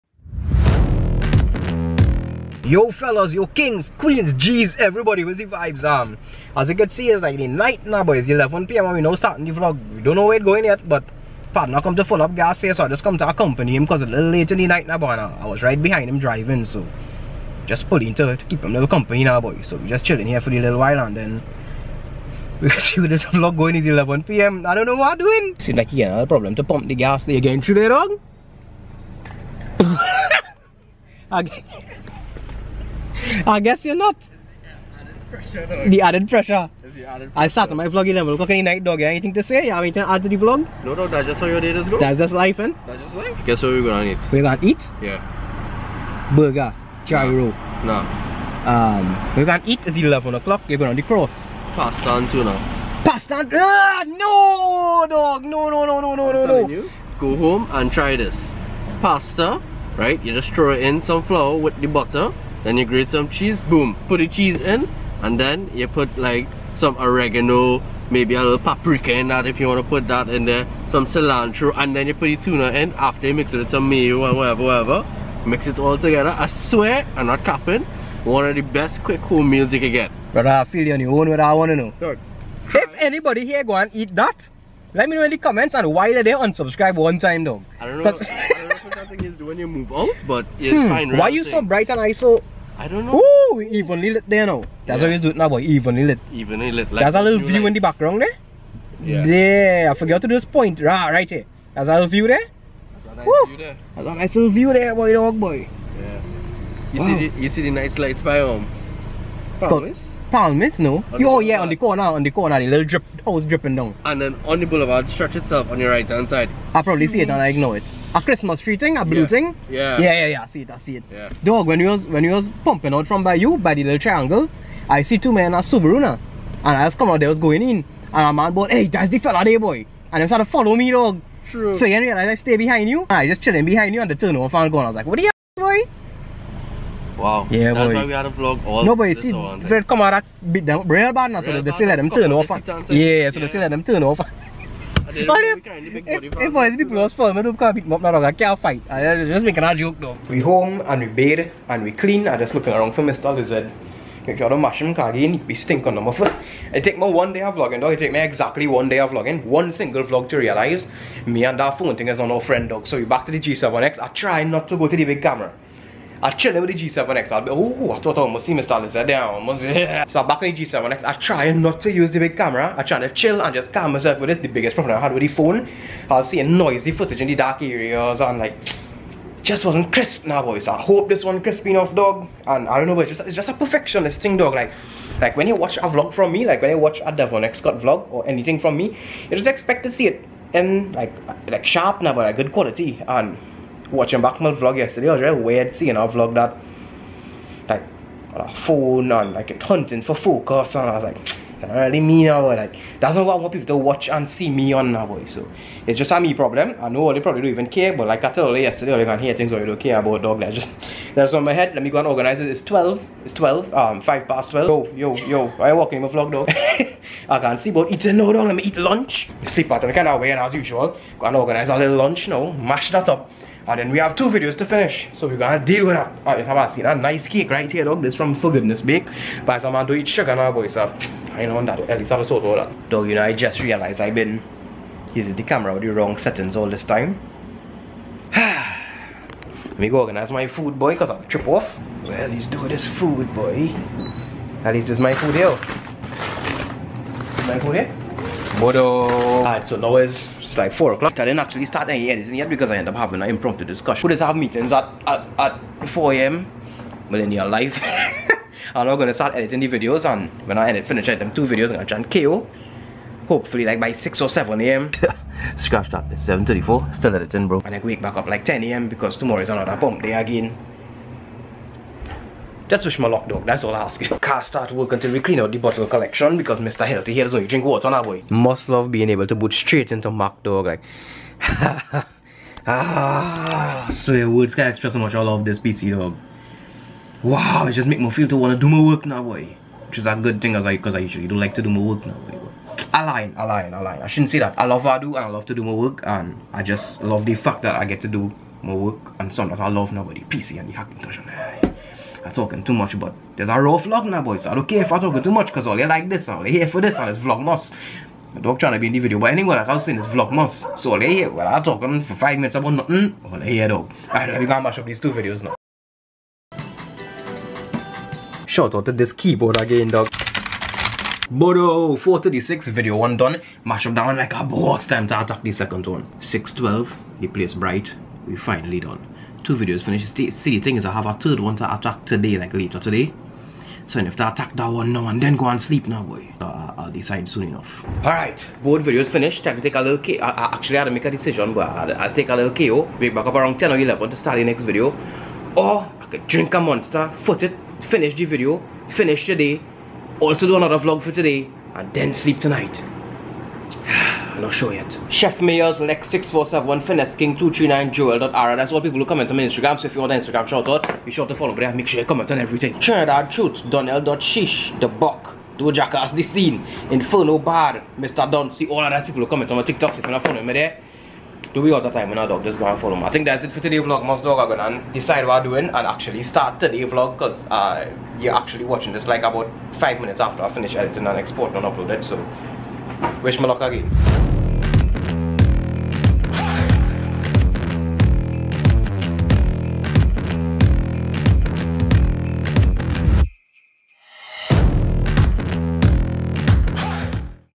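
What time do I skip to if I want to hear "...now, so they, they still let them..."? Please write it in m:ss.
2:21.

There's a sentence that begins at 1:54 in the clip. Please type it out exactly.
And then on the boulevard stretch itself on your right hand side.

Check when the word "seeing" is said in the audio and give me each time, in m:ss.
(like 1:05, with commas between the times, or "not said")
2:56, 3:15.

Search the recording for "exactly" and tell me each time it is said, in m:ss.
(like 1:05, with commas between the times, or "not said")
2:38.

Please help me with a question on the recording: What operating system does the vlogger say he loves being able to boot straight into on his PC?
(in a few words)
Mac.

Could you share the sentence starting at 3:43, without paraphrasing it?
And ah, then we have two videos to finish.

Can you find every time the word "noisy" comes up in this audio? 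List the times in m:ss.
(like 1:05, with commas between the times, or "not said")
2:56.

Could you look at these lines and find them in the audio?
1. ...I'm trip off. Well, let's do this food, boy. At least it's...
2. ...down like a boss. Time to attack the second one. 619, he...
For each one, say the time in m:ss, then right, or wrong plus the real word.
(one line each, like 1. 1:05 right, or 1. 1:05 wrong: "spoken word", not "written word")
1. 4:01 right
2. 5:23 wrong: "612", not "619".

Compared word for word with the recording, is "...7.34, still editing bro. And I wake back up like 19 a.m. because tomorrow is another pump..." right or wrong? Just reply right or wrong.
wrong.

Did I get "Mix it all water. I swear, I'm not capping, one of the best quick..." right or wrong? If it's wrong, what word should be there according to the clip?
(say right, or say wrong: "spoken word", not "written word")
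wrong: "together", not "water".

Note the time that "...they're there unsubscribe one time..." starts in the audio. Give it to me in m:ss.
1:26.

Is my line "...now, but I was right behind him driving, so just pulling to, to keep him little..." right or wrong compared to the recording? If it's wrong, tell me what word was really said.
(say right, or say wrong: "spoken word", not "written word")
right.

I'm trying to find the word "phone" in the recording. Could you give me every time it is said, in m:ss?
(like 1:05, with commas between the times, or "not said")
2:41, 2:55, 3:18.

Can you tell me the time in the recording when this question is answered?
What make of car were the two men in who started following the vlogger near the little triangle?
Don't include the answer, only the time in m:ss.
2:05.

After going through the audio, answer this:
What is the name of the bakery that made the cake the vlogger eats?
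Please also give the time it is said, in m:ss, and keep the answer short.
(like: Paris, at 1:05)
Forgiveness Bake, at 3:48.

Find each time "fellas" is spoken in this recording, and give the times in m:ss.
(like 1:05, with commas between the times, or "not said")
0:02, 2:09.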